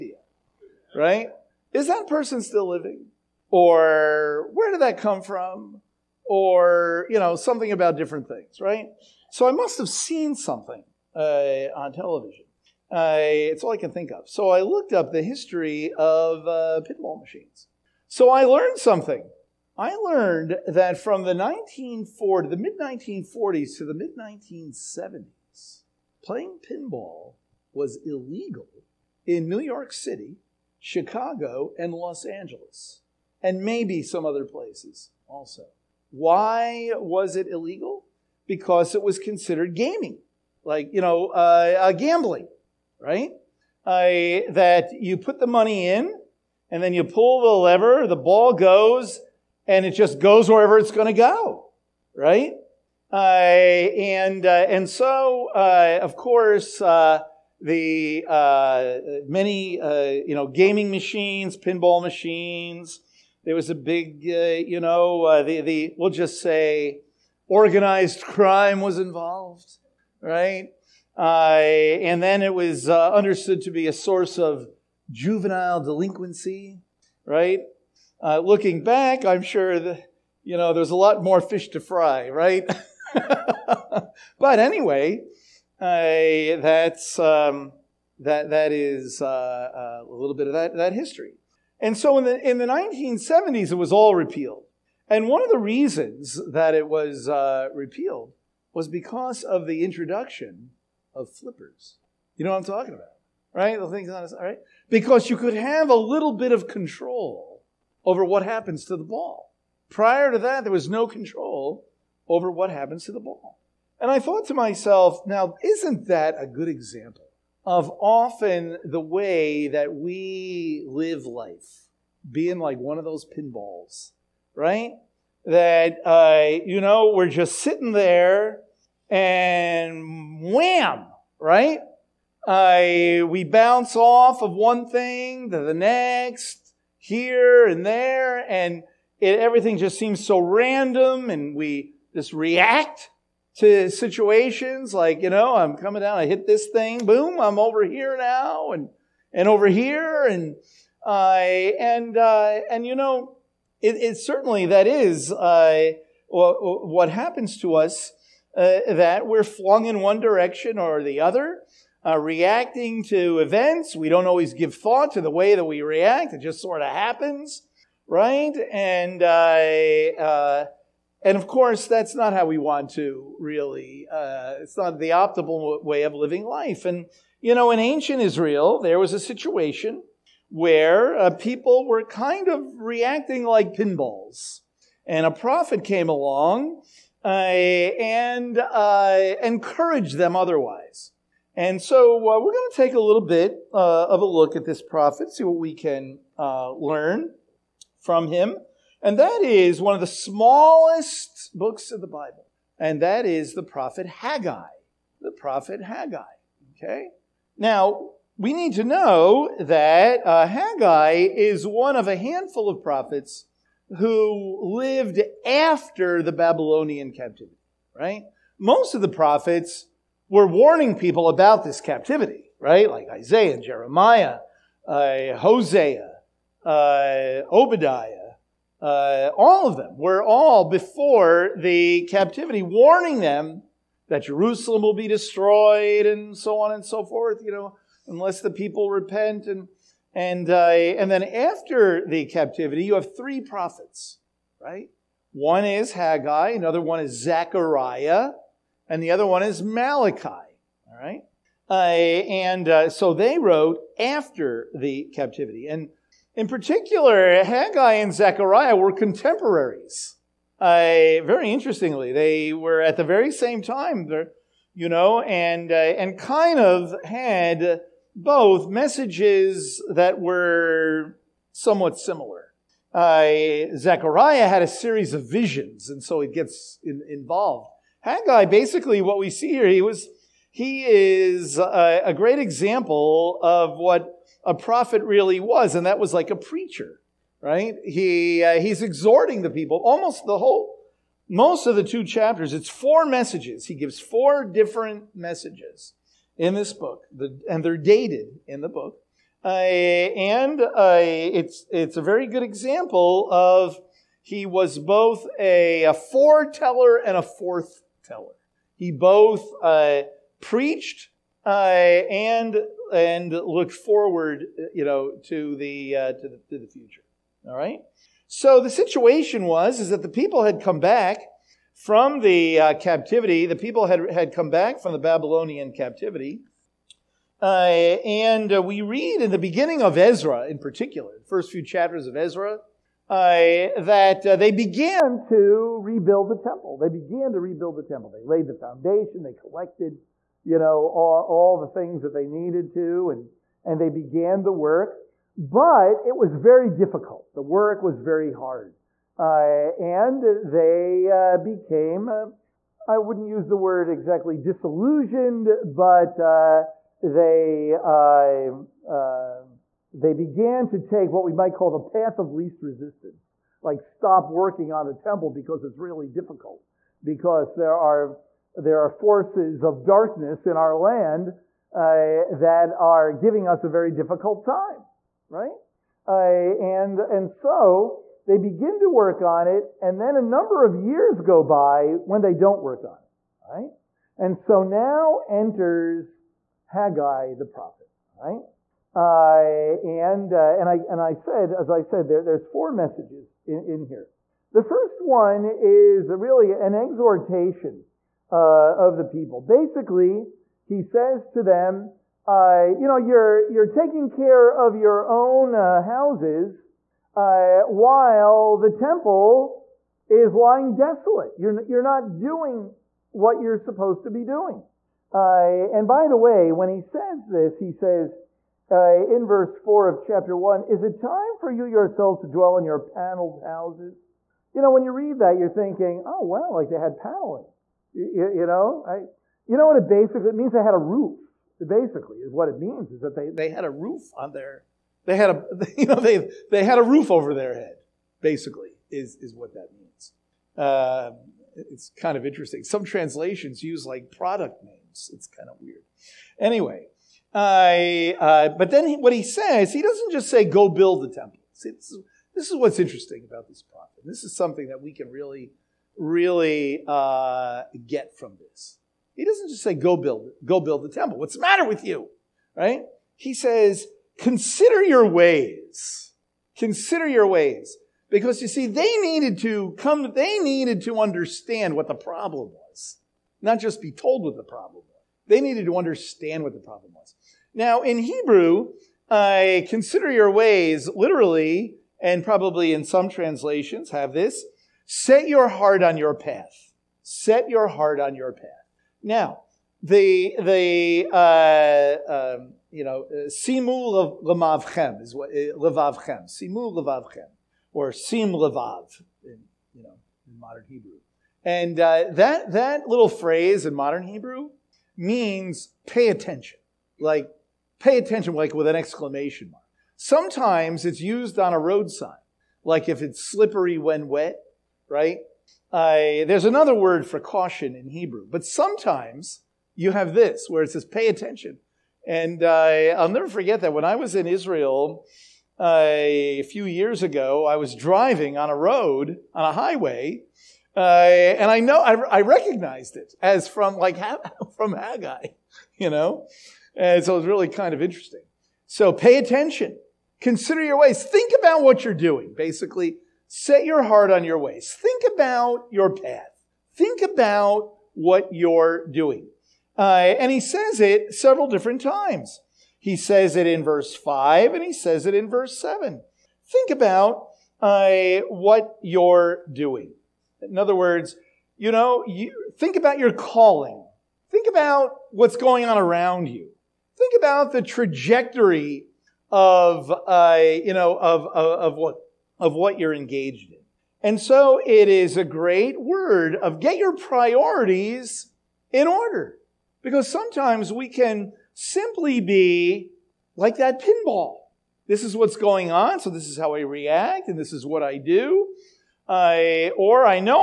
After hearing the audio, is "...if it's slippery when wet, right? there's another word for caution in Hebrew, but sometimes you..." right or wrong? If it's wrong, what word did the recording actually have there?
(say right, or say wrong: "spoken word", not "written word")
right.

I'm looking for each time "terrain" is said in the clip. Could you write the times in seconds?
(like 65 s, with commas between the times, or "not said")
not said.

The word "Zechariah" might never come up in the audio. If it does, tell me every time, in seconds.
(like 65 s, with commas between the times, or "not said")
247 s, 258 s, 273 s.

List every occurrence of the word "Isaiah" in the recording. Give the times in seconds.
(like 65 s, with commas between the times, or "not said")
223 s.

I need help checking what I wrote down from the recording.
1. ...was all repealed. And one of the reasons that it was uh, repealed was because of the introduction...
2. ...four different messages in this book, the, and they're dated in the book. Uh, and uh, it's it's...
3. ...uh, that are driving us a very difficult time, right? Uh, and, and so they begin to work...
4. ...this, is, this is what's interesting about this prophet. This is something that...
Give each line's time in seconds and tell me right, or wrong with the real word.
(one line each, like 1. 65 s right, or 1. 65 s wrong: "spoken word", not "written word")
1. 93 s right
2. 294 s right
3. 371 s wrong: "giving", not "driving"
4. 451 s right.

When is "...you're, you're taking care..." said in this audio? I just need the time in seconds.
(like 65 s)
402 s.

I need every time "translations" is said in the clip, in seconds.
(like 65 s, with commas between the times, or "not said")
442 s, 483 s.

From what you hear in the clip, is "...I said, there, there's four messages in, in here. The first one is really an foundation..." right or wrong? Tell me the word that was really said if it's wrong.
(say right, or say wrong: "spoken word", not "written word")
wrong: "exhortation", not "foundation".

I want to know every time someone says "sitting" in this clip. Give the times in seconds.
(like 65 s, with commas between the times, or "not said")
127 s.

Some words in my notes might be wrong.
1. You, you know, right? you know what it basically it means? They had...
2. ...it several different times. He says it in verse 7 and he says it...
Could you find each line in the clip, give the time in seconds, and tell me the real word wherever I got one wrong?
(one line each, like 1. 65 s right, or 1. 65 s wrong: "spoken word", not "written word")
1. 427 s right
2. 550 s wrong: "5", not "7".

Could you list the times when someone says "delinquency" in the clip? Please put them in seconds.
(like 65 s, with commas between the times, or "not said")
75 s.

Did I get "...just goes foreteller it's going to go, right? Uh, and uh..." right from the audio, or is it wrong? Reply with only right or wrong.
wrong.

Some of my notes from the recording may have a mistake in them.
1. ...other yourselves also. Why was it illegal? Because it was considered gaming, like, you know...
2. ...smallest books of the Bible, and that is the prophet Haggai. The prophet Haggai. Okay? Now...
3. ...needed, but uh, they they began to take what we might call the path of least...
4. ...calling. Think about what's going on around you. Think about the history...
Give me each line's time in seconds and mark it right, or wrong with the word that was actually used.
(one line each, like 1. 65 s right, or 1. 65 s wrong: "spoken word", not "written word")
1. 34 s wrong: "places", not "yourselves"
2. 200 s right
3. 354 s wrong: "disillusioned", not "needed"
4. 563 s wrong: "trajectory", not "history".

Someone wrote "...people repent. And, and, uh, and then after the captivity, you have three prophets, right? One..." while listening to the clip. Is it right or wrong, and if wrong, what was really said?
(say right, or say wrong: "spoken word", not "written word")
right.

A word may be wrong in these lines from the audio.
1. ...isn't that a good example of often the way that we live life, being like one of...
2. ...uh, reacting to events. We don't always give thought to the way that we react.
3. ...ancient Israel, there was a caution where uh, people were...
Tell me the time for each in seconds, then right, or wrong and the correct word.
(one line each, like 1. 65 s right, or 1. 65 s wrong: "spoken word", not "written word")
1. 115 s right
2. 162 s right
3. 177 s wrong: "situation", not "caution".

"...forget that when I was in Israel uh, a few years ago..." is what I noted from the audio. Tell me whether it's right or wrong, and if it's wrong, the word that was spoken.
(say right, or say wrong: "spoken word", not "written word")
right.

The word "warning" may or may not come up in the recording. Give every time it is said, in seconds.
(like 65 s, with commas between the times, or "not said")
220 s, 232 s.